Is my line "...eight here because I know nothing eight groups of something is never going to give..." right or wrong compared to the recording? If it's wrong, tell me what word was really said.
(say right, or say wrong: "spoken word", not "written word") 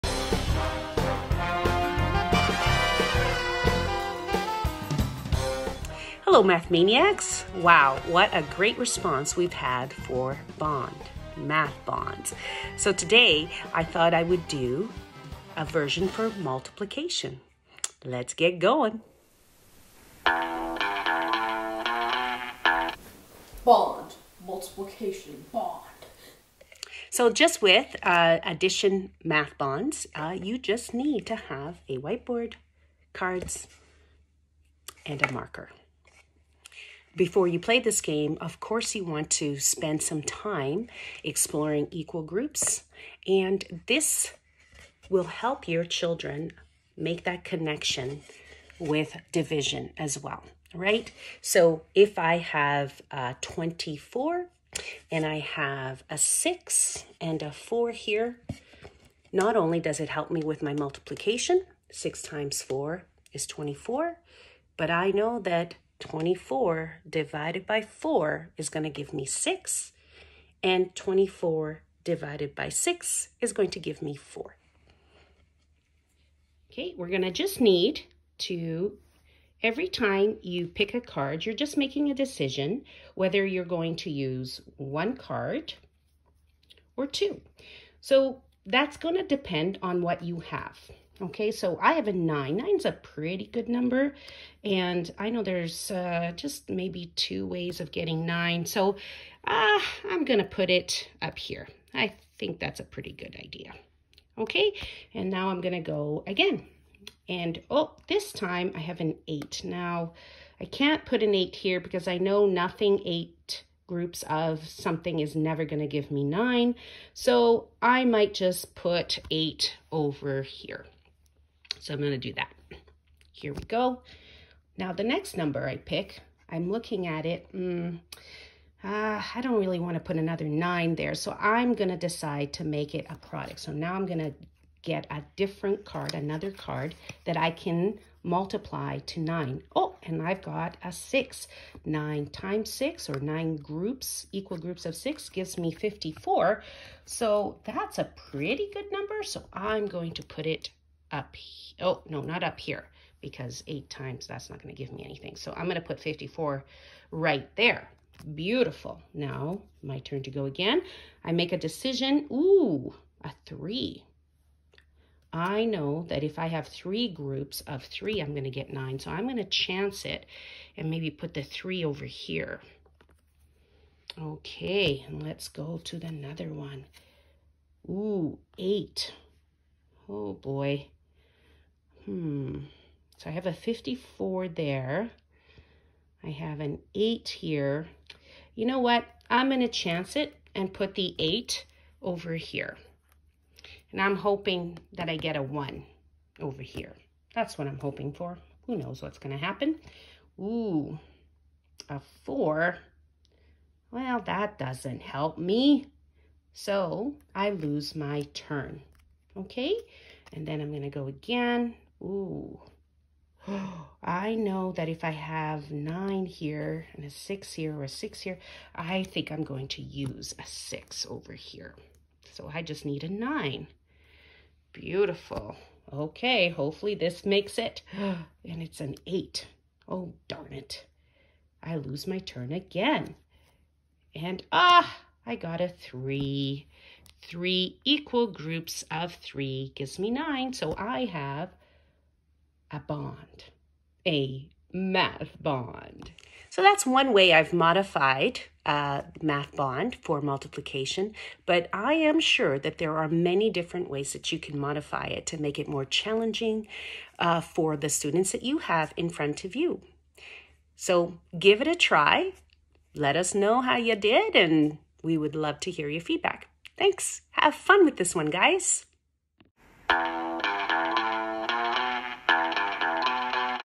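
right.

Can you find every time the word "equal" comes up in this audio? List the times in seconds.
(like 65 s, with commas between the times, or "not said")
41 s, 144 s, 237 s.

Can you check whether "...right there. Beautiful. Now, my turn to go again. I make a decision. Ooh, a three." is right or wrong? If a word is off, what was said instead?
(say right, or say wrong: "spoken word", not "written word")
right.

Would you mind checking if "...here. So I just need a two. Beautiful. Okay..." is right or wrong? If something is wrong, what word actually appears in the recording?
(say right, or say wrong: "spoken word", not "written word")
wrong: "nine", not "two".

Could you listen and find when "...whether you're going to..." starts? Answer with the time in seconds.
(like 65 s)
83 s.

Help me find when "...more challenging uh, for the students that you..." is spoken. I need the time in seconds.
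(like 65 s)
255 s.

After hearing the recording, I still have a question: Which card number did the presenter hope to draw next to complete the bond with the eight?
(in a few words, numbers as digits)
1.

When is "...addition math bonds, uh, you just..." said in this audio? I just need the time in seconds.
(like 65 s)
28 s.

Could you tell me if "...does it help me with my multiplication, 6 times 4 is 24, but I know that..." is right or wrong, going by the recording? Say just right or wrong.
right.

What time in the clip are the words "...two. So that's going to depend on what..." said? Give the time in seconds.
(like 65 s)
87 s.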